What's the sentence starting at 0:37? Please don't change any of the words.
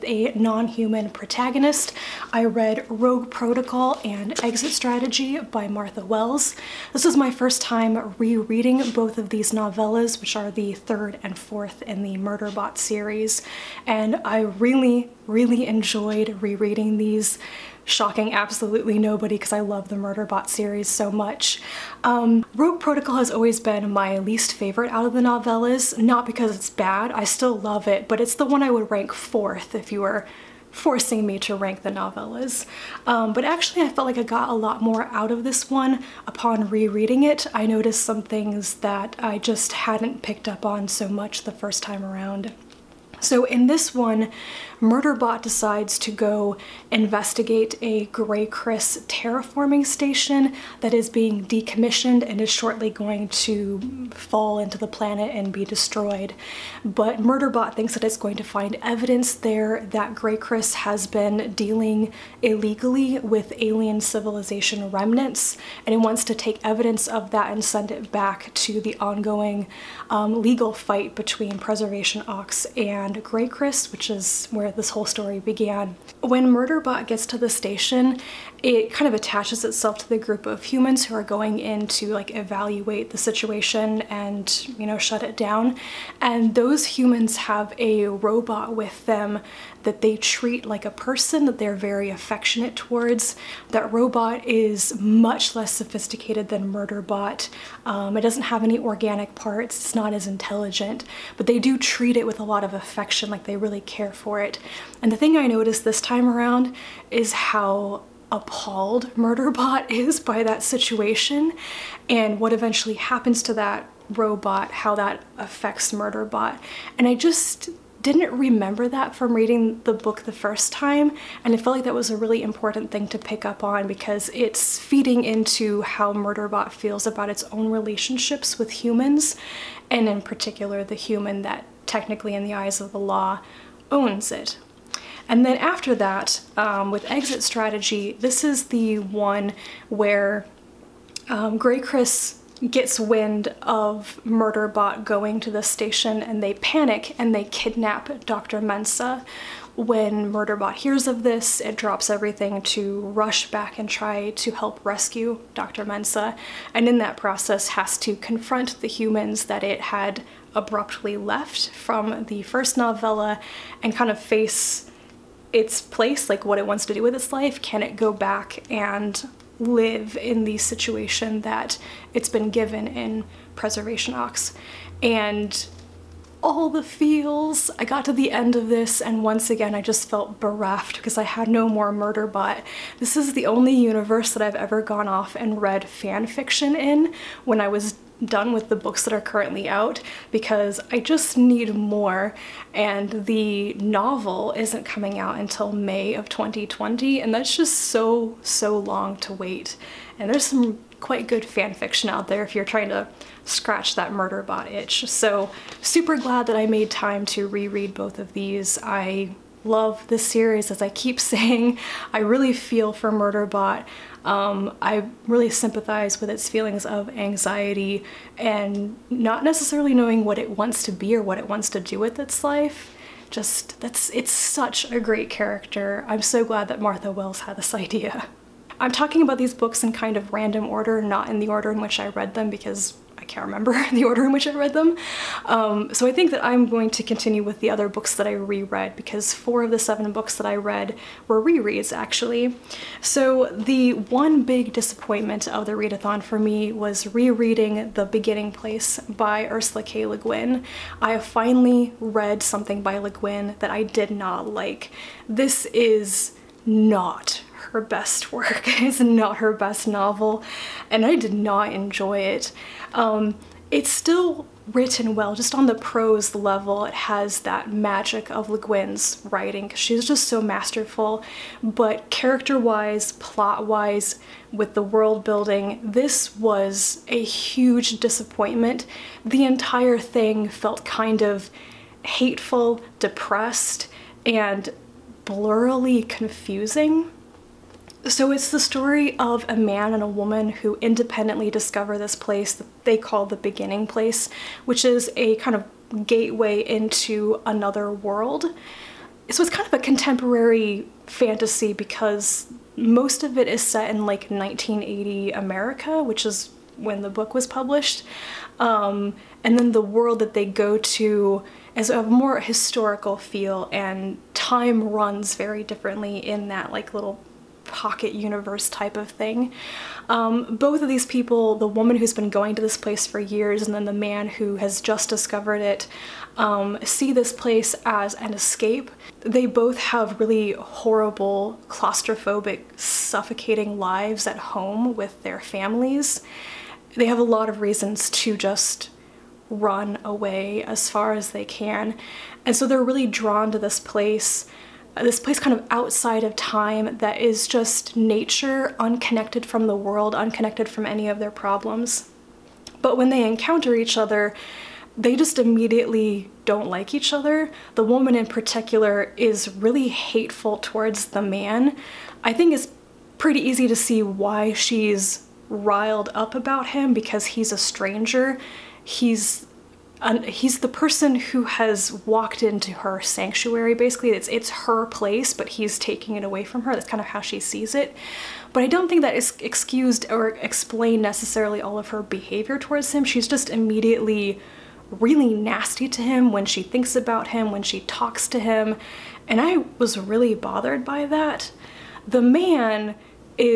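I noticed some things that I just hadn't picked up on so much the first time around.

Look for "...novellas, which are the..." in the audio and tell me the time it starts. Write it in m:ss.
0:09.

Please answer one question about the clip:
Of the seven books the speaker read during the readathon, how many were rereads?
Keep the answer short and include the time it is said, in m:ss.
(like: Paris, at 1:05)
4, at 3:59.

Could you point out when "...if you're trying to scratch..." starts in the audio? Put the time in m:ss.
3:22.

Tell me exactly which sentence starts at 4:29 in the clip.
She's just so masterful, but character-wise, plot-wise, with the world building, this was a huge disappointment.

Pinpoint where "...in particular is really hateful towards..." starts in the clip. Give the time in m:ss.
5:58.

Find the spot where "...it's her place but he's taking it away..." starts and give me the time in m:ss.
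6:14.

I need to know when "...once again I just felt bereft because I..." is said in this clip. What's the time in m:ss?
2:59.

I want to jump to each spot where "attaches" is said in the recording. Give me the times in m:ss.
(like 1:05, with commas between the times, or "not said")
1:19.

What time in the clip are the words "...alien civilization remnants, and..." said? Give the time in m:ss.
1:03.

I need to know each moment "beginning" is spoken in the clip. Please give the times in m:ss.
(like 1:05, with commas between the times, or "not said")
4:08, 4:53.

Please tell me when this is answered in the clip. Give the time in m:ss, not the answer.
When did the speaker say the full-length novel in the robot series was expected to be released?
3:15.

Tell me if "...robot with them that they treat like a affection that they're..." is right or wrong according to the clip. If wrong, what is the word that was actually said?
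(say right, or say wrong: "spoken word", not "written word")
wrong: "person", not "affection".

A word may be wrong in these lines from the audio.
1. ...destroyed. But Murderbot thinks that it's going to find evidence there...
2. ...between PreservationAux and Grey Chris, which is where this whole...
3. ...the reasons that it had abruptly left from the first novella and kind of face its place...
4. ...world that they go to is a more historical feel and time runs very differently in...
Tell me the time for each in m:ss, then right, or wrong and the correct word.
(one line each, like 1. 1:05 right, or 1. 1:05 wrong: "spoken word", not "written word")
1. 0:55 right
2. 1:11 right
3. 2:38 wrong: "humans", not "reasons"
4. 5:09 right.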